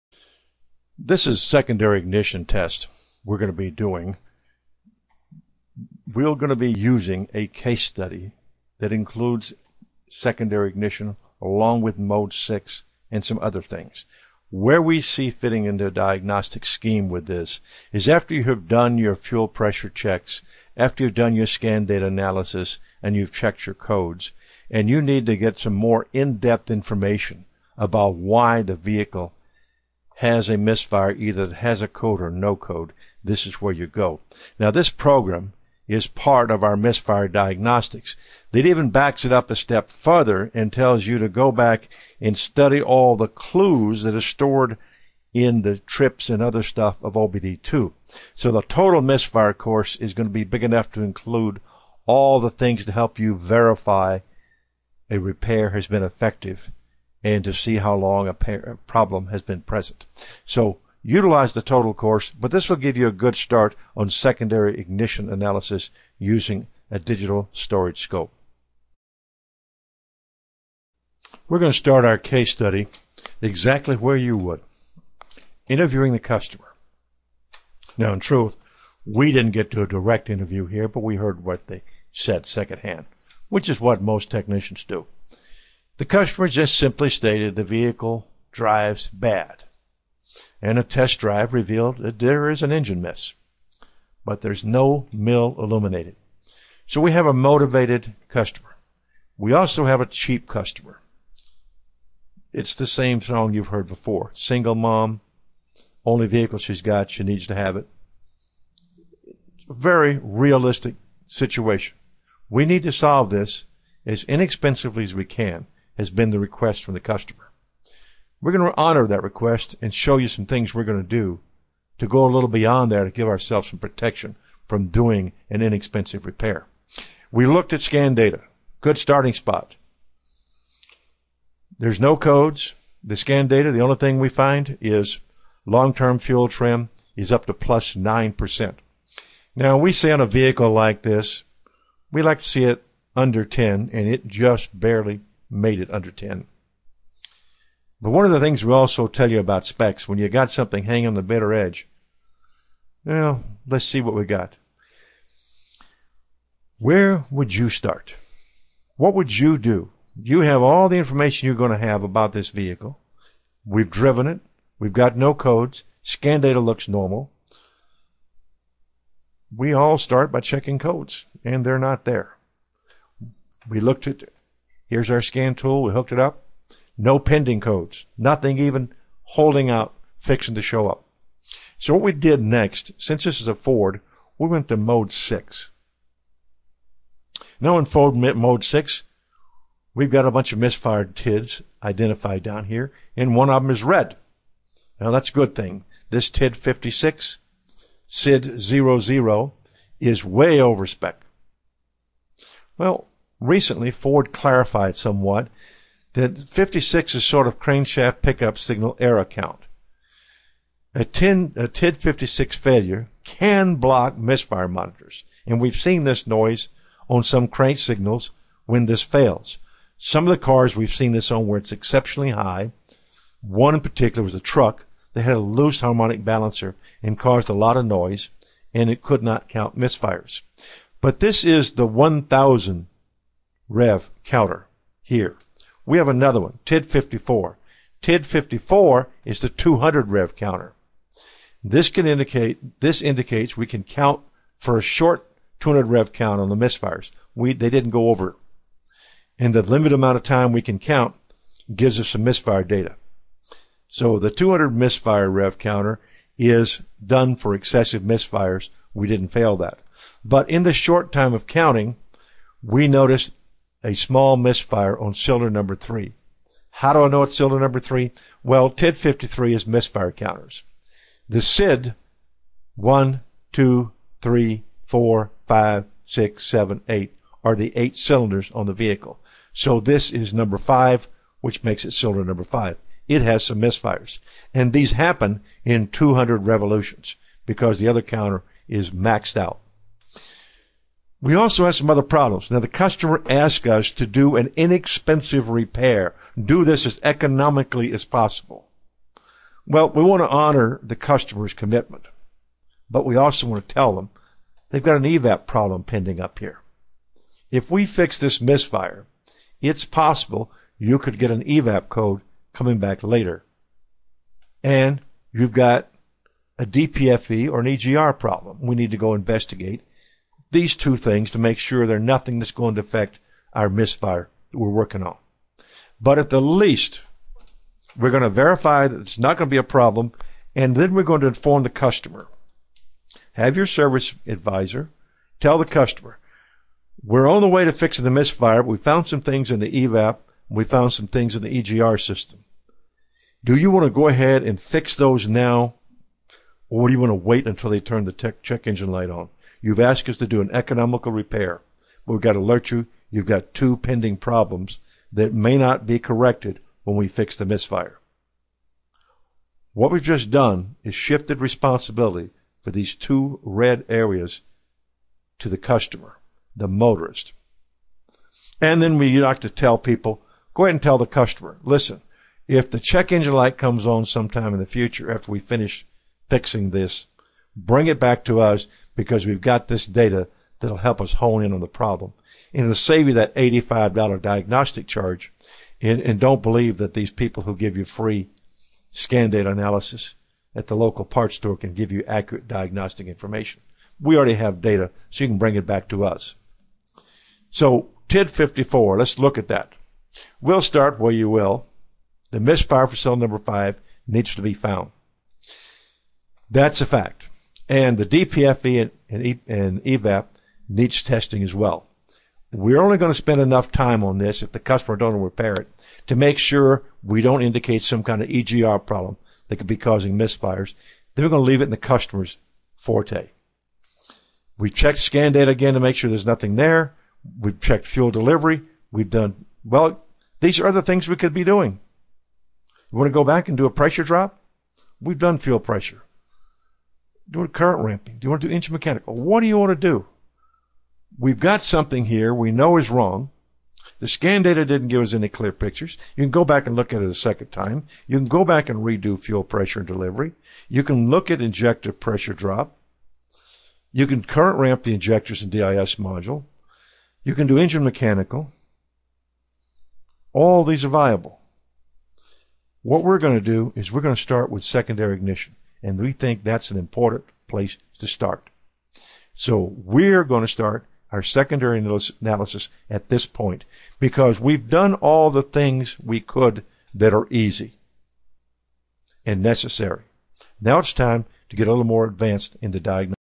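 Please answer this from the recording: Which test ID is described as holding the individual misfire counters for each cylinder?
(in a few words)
TID 53.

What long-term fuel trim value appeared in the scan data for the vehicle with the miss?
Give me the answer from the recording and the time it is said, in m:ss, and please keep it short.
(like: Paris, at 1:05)
+9%, at 2:17.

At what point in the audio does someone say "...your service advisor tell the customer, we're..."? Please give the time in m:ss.
5:33.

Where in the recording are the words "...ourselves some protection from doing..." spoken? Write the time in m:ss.
2:03.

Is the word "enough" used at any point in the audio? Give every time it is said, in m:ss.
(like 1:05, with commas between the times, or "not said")
0:50, 6:53.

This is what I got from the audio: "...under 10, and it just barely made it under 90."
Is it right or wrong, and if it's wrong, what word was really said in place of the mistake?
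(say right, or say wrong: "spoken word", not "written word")
wrong: "10", not "90".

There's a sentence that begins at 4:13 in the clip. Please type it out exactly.
So the 200 misfire rev counter is done for excessive misfires.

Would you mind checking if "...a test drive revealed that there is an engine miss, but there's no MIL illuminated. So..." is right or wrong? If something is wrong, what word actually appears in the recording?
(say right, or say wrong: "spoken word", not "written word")
right.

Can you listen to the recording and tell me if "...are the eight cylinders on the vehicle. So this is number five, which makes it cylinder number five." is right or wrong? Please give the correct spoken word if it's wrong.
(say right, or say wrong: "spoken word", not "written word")
right.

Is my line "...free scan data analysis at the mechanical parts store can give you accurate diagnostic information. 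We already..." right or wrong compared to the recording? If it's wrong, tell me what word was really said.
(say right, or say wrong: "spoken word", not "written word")
wrong: "local", not "mechanical".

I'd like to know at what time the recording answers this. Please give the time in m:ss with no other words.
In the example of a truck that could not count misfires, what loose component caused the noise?
3:45.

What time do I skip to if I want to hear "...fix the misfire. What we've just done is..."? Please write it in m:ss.
5:57.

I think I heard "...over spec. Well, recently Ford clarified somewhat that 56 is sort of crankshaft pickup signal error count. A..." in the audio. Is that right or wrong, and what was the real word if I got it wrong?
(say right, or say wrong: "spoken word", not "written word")
right.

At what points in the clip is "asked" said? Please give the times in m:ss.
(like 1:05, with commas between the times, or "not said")
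4:53, 5:49.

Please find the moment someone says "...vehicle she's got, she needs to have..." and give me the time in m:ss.
1:46.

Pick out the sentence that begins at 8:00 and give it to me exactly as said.
Now it's time to get a little more advanced in the diagnosis.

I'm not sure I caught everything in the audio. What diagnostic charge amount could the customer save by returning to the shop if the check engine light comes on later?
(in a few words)
$85.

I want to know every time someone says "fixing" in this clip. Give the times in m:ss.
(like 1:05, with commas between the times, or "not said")
3:00, 5:37, 6:16.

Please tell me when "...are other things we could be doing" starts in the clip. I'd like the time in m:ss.
7:10.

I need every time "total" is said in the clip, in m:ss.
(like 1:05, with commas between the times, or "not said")
0:48, 1:01.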